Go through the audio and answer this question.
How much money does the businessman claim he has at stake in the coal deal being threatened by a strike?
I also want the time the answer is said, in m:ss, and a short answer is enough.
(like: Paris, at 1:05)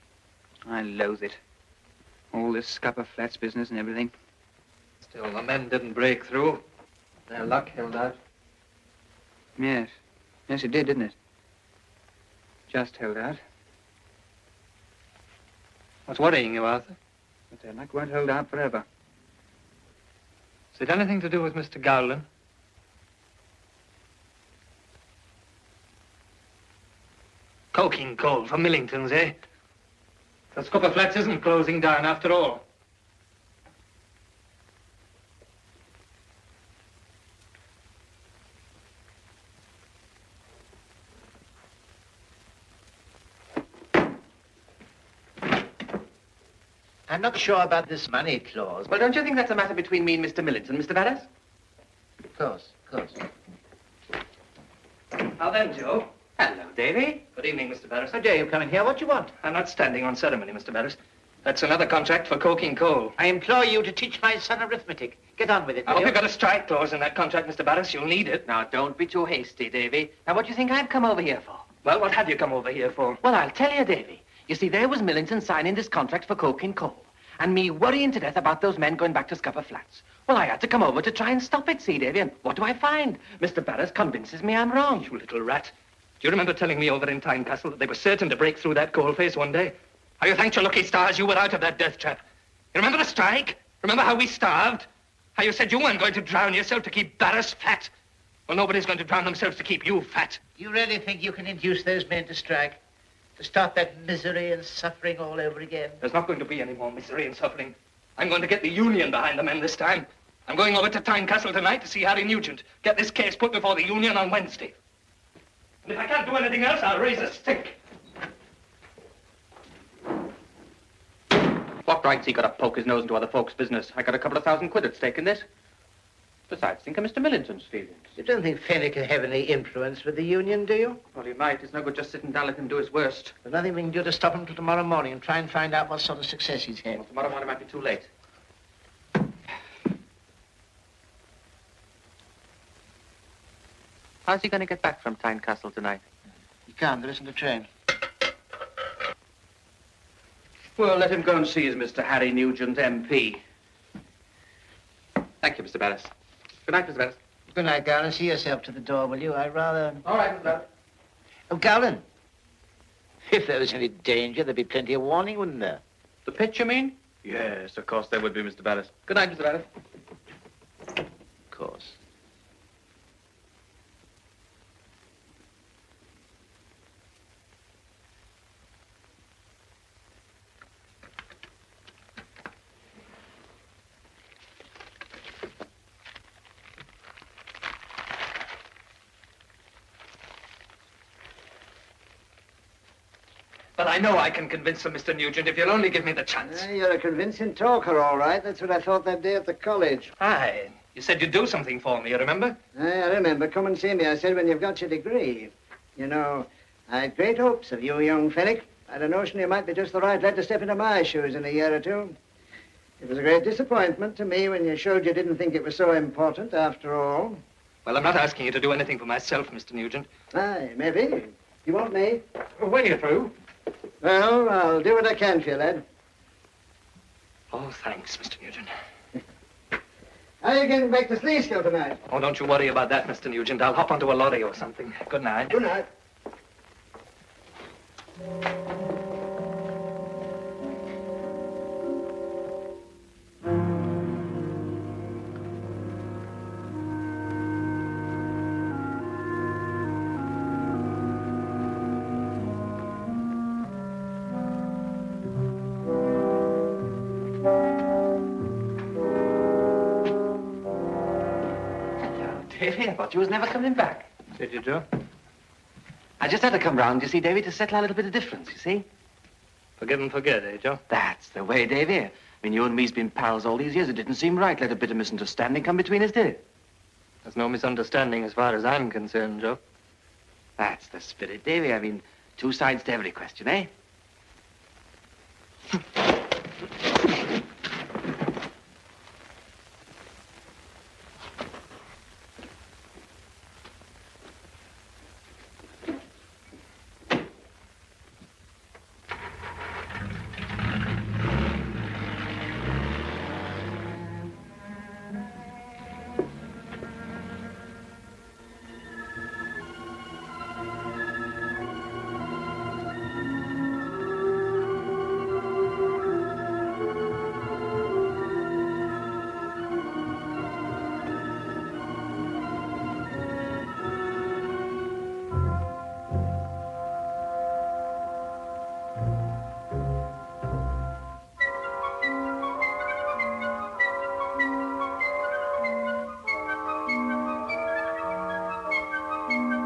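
A couple of thousand quid, at 2:04.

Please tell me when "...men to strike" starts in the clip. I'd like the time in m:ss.
1:42.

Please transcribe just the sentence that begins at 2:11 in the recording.
It's no good just sitting down and let do his worst.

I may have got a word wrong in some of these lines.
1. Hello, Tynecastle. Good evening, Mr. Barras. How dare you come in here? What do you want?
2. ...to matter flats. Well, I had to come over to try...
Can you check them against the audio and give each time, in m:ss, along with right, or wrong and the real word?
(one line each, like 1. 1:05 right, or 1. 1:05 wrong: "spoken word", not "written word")
1. 0:56 wrong: "Davy", not "Tynecastle"
2. 1:19 wrong: "scupper", not "matter".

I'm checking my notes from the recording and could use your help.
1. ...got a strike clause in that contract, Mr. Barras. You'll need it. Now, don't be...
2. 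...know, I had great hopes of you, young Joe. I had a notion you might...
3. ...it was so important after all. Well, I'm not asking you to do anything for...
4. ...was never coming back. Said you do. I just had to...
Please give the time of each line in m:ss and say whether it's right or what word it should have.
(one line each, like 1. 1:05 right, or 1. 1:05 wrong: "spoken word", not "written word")
1. 1:06 right
2. 3:26 wrong: "Fenwick", not "Joe"
3. 3:35 right
4. 4:23 right.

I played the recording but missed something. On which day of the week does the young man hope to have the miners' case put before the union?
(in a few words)
Wednesday.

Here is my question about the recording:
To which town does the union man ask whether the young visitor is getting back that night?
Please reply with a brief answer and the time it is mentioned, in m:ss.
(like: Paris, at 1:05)
Sleescale, at 3:51.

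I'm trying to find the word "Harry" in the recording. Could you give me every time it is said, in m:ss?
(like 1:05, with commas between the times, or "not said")
1:52, 2:32.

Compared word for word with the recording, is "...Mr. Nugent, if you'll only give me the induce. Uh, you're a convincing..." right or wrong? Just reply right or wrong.
wrong.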